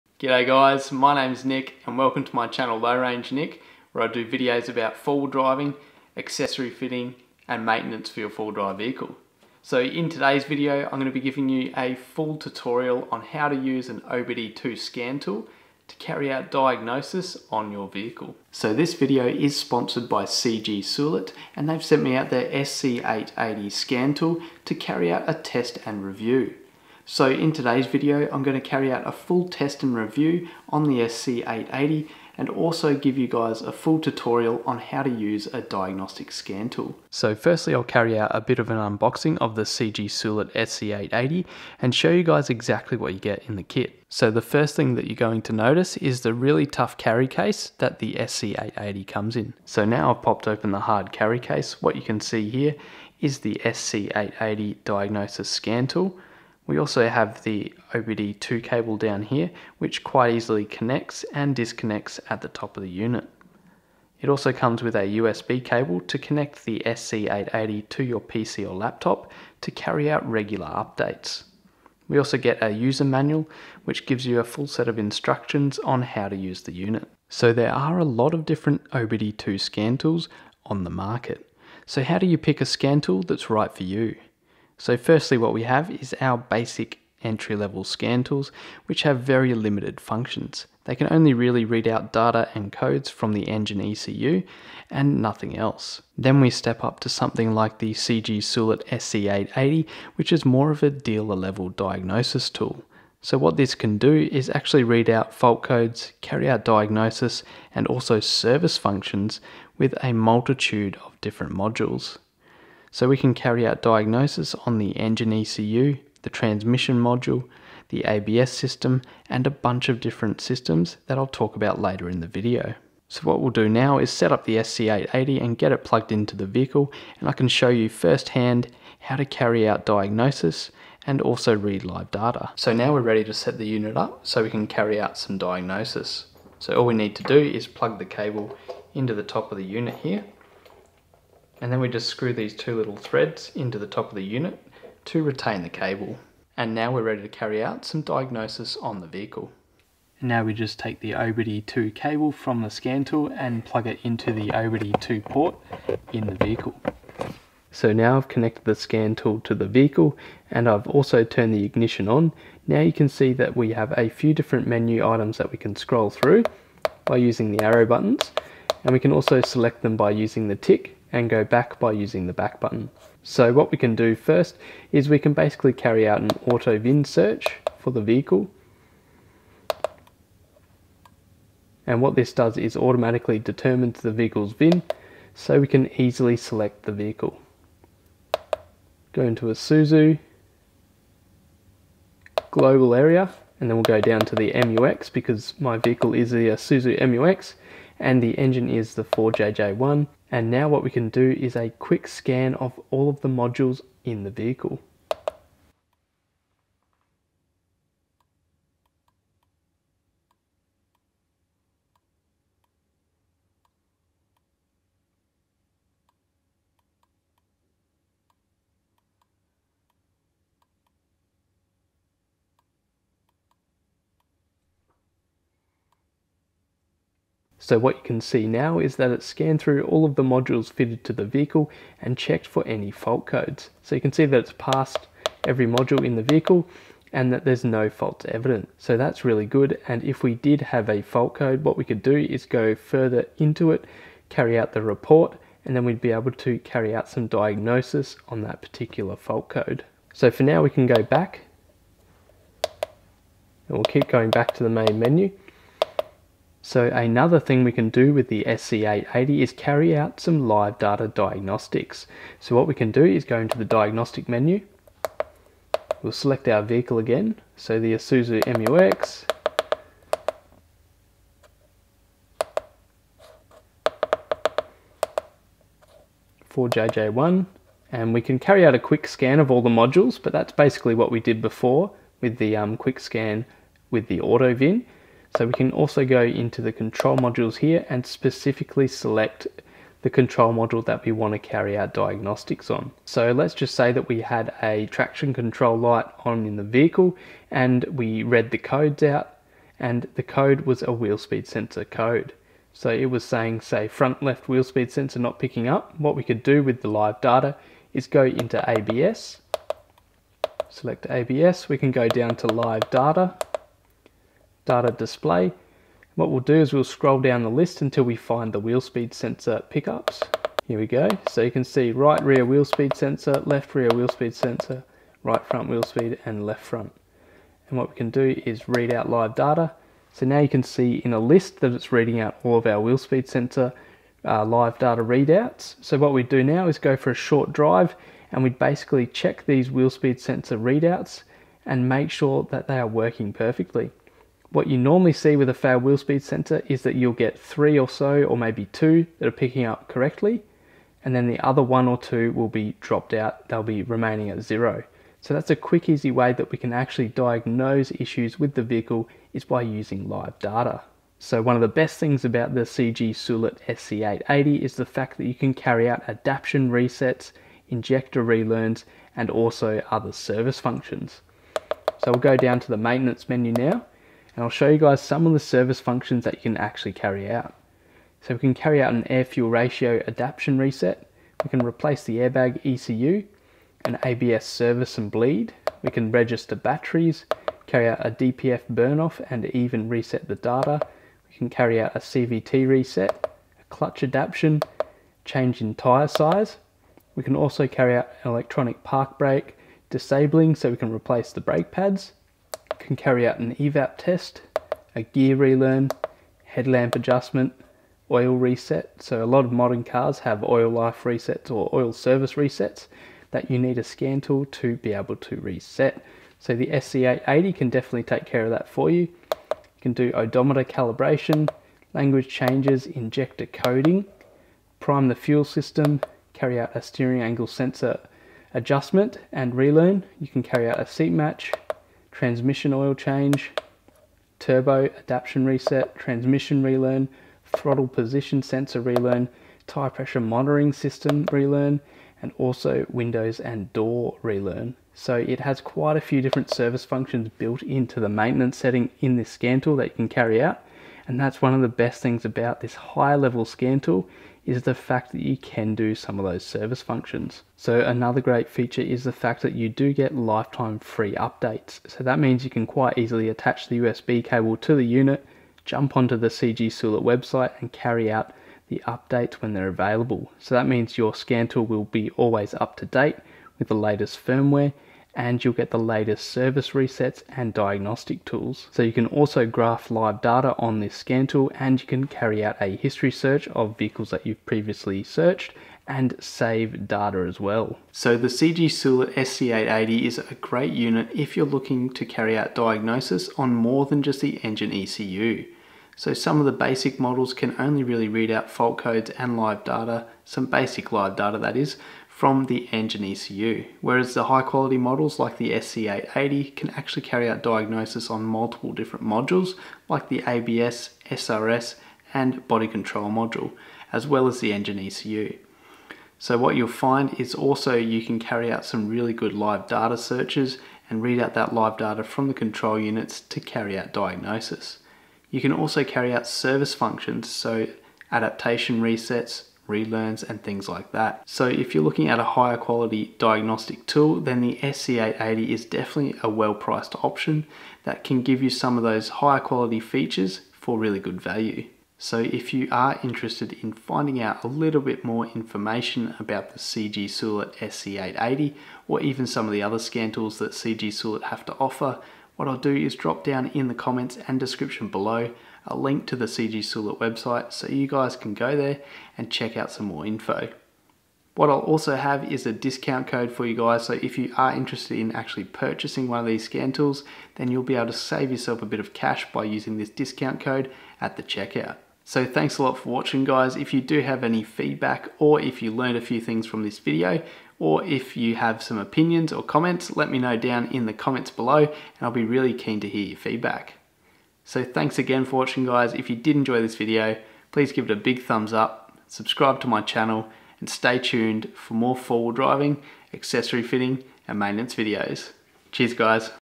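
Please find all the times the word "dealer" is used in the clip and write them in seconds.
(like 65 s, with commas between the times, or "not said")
100 s.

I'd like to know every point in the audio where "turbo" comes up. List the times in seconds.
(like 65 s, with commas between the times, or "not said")
434 s.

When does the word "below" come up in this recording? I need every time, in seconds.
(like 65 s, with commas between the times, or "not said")
554 s, 581 s.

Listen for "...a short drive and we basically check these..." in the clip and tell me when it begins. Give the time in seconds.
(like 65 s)
337 s.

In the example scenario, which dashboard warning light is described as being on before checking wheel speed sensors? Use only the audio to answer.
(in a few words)
Traction control light.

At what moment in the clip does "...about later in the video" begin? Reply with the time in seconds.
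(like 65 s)
121 s.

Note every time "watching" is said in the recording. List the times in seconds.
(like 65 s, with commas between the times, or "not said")
572 s, 585 s.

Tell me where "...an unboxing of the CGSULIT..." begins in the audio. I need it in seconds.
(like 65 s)
38 s.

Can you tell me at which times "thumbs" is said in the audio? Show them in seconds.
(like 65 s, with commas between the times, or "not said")
588 s.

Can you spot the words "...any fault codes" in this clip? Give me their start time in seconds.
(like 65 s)
232 s.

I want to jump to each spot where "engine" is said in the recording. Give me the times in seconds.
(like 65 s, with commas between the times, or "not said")
93 s, 114 s, 198 s, 494 s, 502 s, 514 s.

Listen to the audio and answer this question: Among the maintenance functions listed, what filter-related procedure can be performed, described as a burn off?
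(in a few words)
DPF burn off.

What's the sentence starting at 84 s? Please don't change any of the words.
So firstly, what we have is our basic entry level scan tools, which have very limited functions.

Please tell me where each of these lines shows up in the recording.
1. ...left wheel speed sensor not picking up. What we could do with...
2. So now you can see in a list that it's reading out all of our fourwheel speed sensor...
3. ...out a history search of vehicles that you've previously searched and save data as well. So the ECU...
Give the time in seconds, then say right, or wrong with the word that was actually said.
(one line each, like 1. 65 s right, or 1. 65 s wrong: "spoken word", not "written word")
1. 304 s right
2. 330 s wrong: "wheel", not "fourwheel"
3. 482 s wrong: "CGSULIT", not "ECU".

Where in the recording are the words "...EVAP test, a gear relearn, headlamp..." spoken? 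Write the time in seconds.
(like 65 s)
403 s.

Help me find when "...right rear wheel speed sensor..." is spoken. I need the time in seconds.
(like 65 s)
321 s.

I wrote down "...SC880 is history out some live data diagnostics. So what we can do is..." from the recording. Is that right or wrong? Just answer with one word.
wrong.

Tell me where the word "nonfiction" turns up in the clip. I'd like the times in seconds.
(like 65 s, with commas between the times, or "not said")
not said.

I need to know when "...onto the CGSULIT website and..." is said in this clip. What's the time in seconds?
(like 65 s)
465 s.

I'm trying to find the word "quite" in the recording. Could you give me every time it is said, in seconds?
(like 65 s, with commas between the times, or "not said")
60 s, 445 s, 462 s.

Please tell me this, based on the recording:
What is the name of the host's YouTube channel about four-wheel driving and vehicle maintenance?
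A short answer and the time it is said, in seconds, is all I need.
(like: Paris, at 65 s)
Low Range Nick, at 2 s.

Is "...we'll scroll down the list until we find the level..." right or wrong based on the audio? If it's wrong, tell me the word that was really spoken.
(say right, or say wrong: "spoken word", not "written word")
wrong: "wheel", not "level".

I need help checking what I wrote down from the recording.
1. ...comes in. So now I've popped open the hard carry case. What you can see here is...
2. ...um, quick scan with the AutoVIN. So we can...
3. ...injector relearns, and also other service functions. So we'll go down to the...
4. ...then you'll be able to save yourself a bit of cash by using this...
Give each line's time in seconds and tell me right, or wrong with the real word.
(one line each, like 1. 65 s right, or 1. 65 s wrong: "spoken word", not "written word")
1. 49 s right
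2. 282 s right
3. 367 s right
4. 567 s right.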